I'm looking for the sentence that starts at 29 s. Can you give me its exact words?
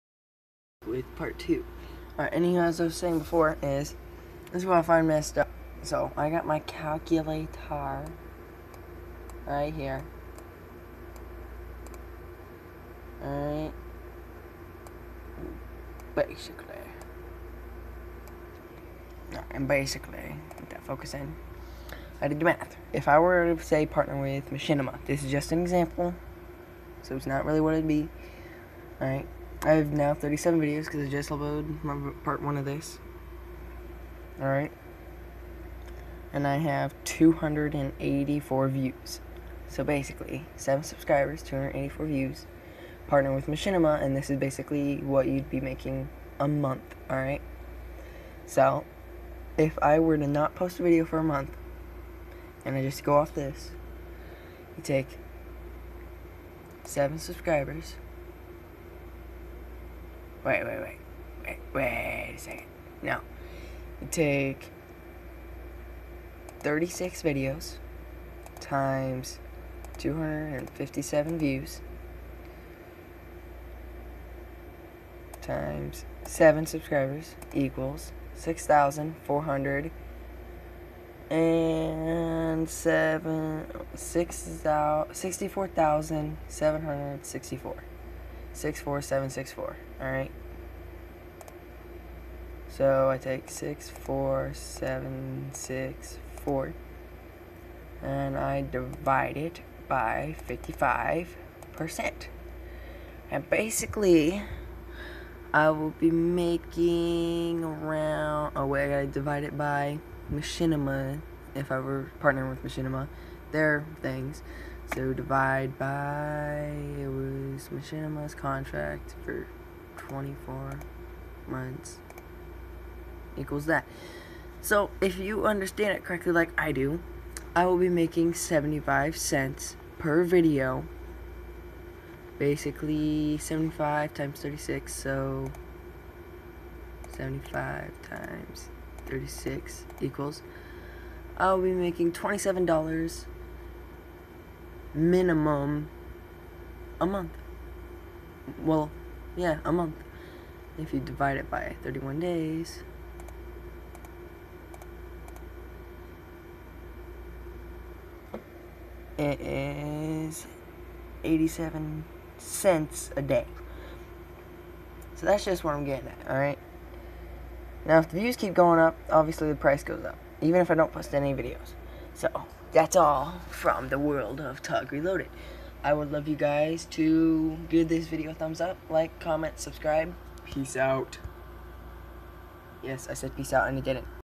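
Alright, I have now 37 videos because I just uploaded my part one of this.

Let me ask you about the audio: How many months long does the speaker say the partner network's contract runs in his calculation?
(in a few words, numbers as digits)
24 months.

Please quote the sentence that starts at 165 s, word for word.
So that's just what I'm getting at, alright?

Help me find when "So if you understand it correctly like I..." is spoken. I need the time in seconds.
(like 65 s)
124 s.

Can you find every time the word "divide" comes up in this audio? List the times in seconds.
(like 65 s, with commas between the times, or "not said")
98 s, 109 s, 115 s, 150 s.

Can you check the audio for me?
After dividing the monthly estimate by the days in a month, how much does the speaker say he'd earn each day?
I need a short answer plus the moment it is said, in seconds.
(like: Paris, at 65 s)
87 cents, at 161 s.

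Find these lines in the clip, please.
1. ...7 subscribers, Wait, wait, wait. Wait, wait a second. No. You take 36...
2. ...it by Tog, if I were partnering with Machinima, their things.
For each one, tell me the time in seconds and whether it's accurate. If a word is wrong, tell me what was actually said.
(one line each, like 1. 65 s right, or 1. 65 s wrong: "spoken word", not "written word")
1. 56 s right
2. 109 s wrong: "Machinima", not "Tog".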